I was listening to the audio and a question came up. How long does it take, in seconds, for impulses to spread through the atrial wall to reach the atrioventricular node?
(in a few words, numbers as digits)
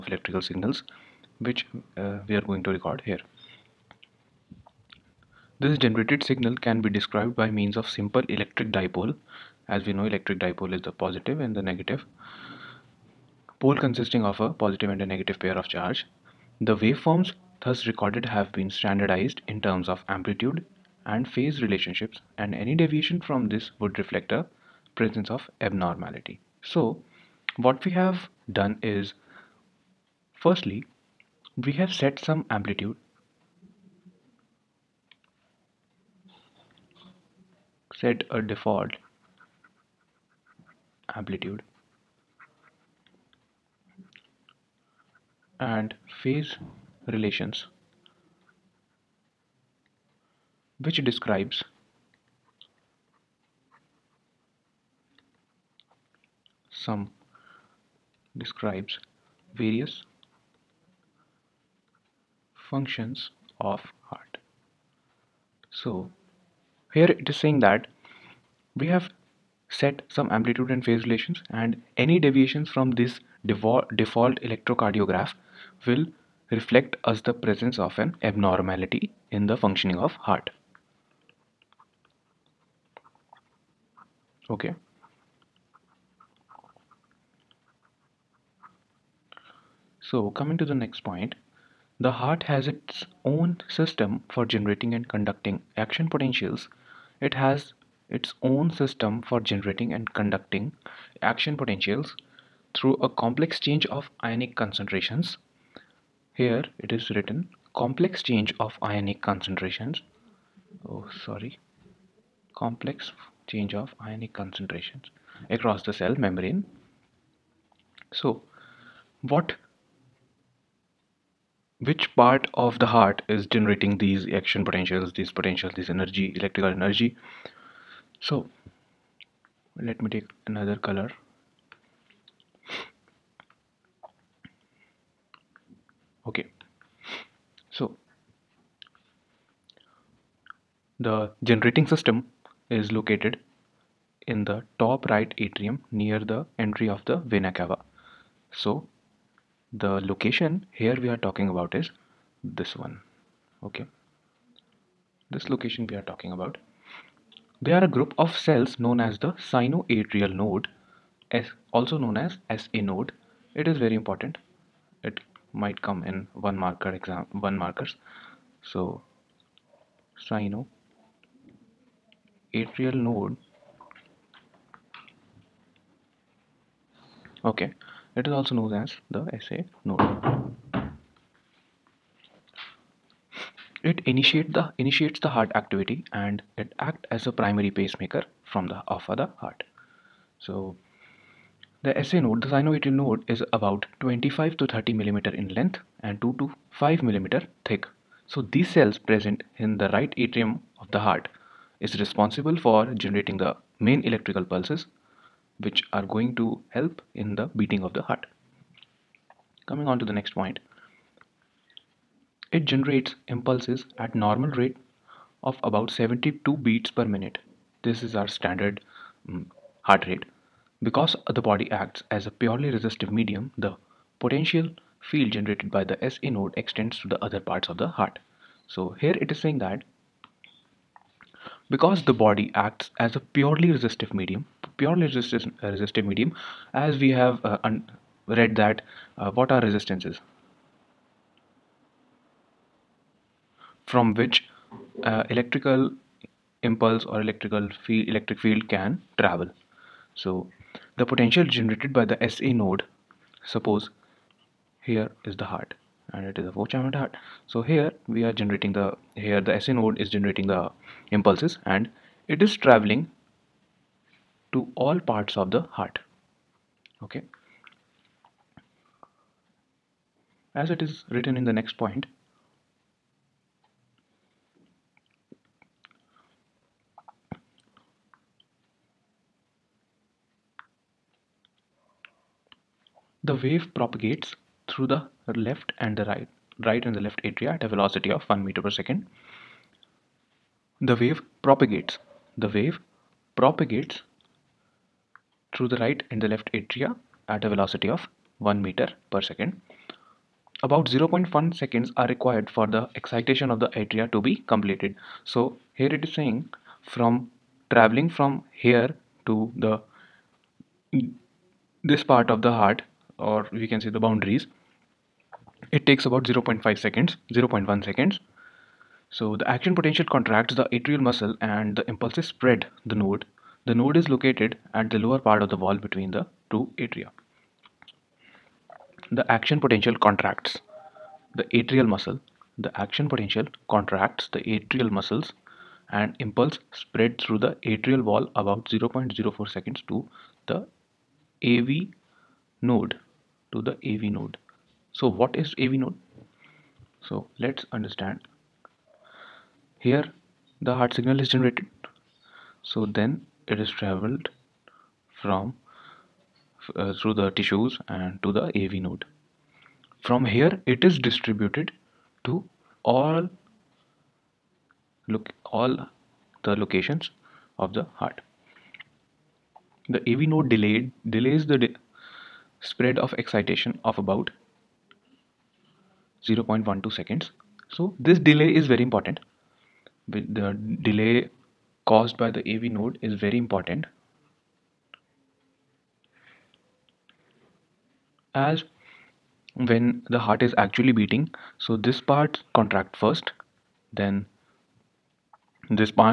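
0.04 seconds.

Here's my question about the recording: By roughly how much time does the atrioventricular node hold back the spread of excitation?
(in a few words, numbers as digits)
0.12 seconds.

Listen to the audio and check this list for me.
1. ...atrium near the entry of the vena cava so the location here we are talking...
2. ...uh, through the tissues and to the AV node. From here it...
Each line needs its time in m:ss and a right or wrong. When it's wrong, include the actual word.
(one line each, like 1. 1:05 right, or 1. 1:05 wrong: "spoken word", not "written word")
1. 2:25 right
2. 5:56 right.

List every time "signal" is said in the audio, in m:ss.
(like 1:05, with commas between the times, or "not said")
0:00, 0:06, 5:50.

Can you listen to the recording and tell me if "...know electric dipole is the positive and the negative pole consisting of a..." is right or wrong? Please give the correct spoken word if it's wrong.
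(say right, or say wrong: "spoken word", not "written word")
right.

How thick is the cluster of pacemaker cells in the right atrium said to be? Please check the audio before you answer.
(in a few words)
2 to 5 millimeters.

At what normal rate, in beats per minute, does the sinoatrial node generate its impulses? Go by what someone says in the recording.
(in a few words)
72.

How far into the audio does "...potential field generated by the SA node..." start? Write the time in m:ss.
3:44.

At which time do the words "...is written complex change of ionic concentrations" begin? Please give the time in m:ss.
1:46.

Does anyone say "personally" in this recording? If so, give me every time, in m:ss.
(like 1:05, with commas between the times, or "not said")
not said.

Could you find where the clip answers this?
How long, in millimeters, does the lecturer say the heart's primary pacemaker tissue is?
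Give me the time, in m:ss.
3:14.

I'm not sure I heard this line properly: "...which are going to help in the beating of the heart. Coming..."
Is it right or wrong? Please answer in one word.
right.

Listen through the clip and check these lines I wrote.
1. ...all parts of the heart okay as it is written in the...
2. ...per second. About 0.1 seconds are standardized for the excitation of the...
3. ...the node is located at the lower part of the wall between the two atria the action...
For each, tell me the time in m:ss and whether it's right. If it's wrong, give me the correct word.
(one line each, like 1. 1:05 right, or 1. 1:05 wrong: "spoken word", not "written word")
1. 4:24 right
2. 4:59 wrong: "required", not "standardized"
3. 5:23 right.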